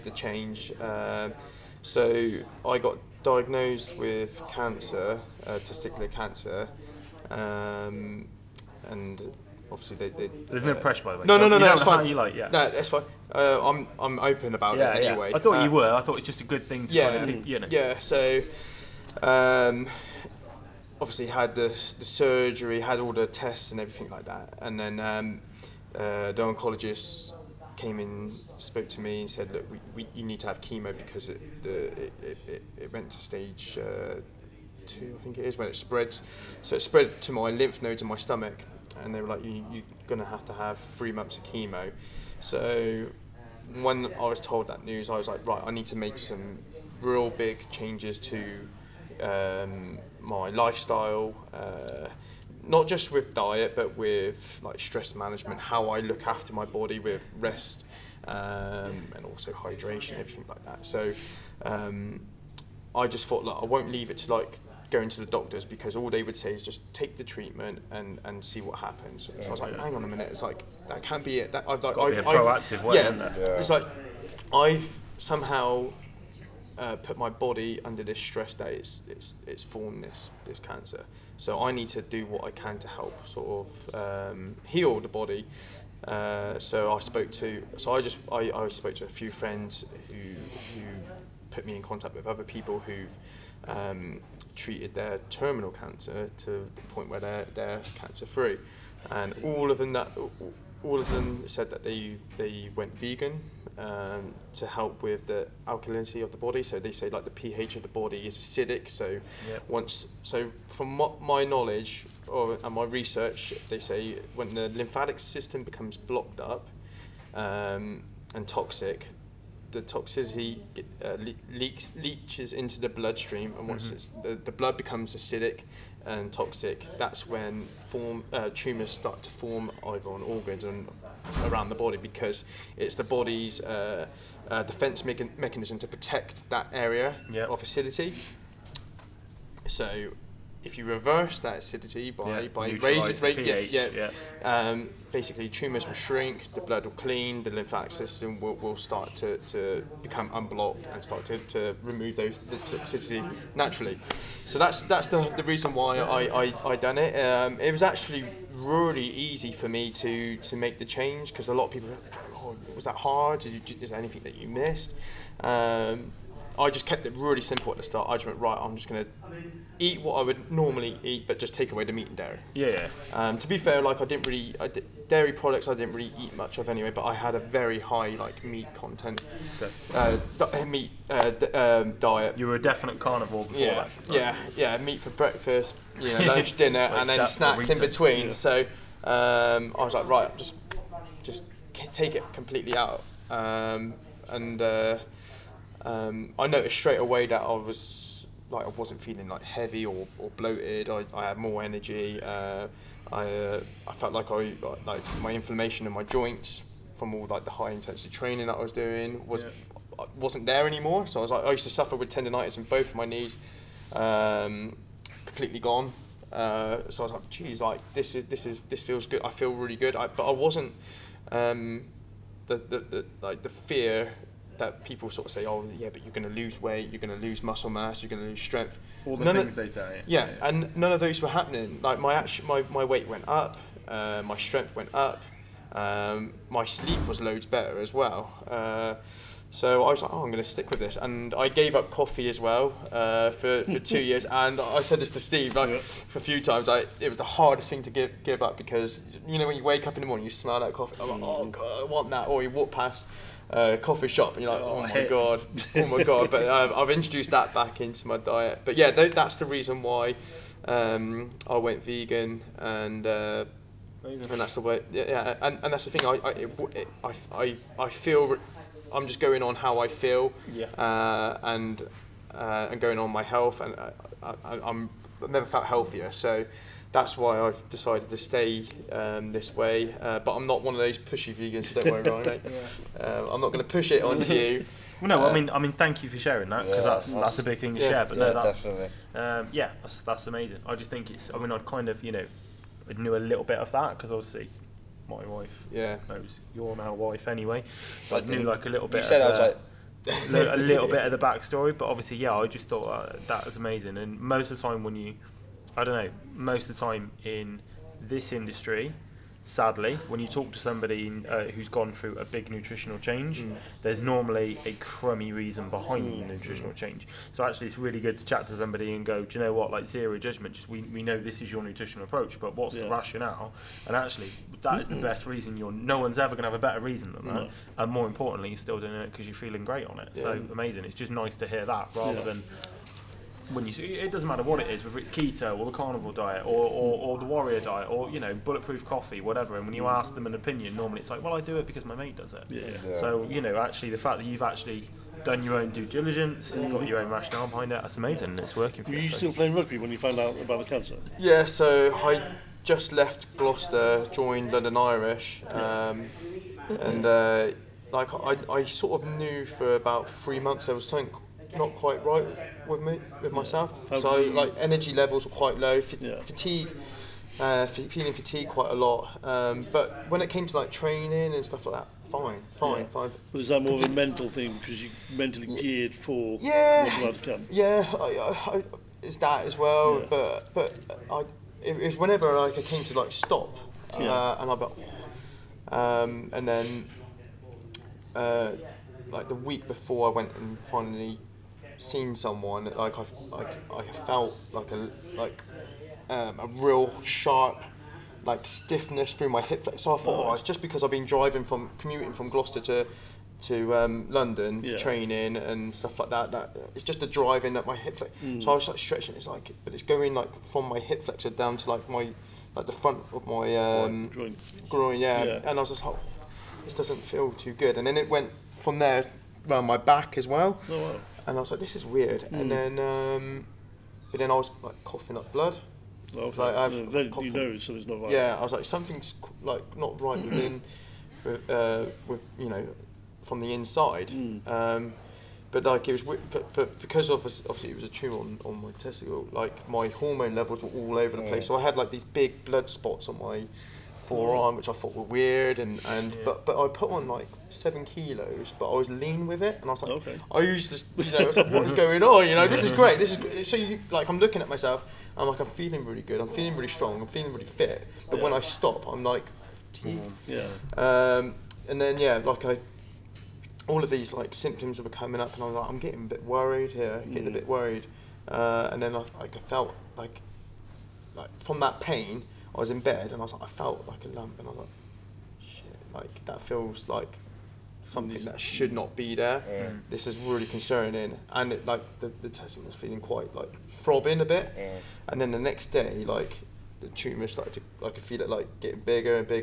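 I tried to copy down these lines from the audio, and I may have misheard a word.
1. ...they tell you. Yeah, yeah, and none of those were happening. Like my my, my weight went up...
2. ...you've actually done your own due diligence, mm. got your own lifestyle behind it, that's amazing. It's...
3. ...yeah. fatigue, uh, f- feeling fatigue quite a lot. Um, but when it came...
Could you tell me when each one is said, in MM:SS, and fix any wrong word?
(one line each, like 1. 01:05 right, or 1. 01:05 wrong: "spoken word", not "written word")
1. 03:49 right
2. 05:44 wrong: "rationale", not "lifestyle"
3. 06:05 right.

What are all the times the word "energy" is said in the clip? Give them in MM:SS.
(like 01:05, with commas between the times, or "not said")
03:21, 06:04.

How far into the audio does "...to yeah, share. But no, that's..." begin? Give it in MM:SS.
04:47.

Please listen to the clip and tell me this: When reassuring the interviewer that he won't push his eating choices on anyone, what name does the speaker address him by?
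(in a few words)
Ryan.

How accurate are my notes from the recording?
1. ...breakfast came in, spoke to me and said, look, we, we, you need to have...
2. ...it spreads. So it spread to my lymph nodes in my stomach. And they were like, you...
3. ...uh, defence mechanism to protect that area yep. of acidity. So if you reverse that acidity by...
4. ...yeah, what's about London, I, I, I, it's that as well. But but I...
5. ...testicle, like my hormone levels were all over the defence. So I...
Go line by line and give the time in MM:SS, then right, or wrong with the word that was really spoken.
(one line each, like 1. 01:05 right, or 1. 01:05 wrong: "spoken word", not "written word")
1. 00:26 wrong: "oncologist", not "breakfast"
2. 00:35 right
3. 02:14 right
4. 06:16 wrong: "Yeah", not "London"
5. 07:18 wrong: "place", not "defence".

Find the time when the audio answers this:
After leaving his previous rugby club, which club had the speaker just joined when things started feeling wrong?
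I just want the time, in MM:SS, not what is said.
05:54.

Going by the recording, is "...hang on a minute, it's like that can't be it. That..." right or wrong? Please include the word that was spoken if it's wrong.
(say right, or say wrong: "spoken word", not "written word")
right.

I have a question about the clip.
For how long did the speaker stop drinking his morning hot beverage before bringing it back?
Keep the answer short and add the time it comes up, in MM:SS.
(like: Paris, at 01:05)
2 years, at 04:03.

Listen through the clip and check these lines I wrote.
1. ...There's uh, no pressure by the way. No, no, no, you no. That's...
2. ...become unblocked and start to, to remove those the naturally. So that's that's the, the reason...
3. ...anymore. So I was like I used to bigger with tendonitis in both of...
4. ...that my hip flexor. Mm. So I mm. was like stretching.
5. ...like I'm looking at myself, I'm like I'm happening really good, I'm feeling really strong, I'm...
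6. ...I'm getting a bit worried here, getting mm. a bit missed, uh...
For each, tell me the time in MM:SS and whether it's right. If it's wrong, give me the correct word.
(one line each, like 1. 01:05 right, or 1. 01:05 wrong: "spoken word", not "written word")
1. 00:10 right
2. 02:30 right
3. 03:30 wrong: "suffer", not "bigger"
4. 06:47 right
5. 07:33 wrong: "feeling", not "happening"
6. 07:45 wrong: "worried", not "missed".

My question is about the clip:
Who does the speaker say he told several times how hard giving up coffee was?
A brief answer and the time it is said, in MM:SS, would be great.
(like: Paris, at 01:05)
Steve, at 04:05.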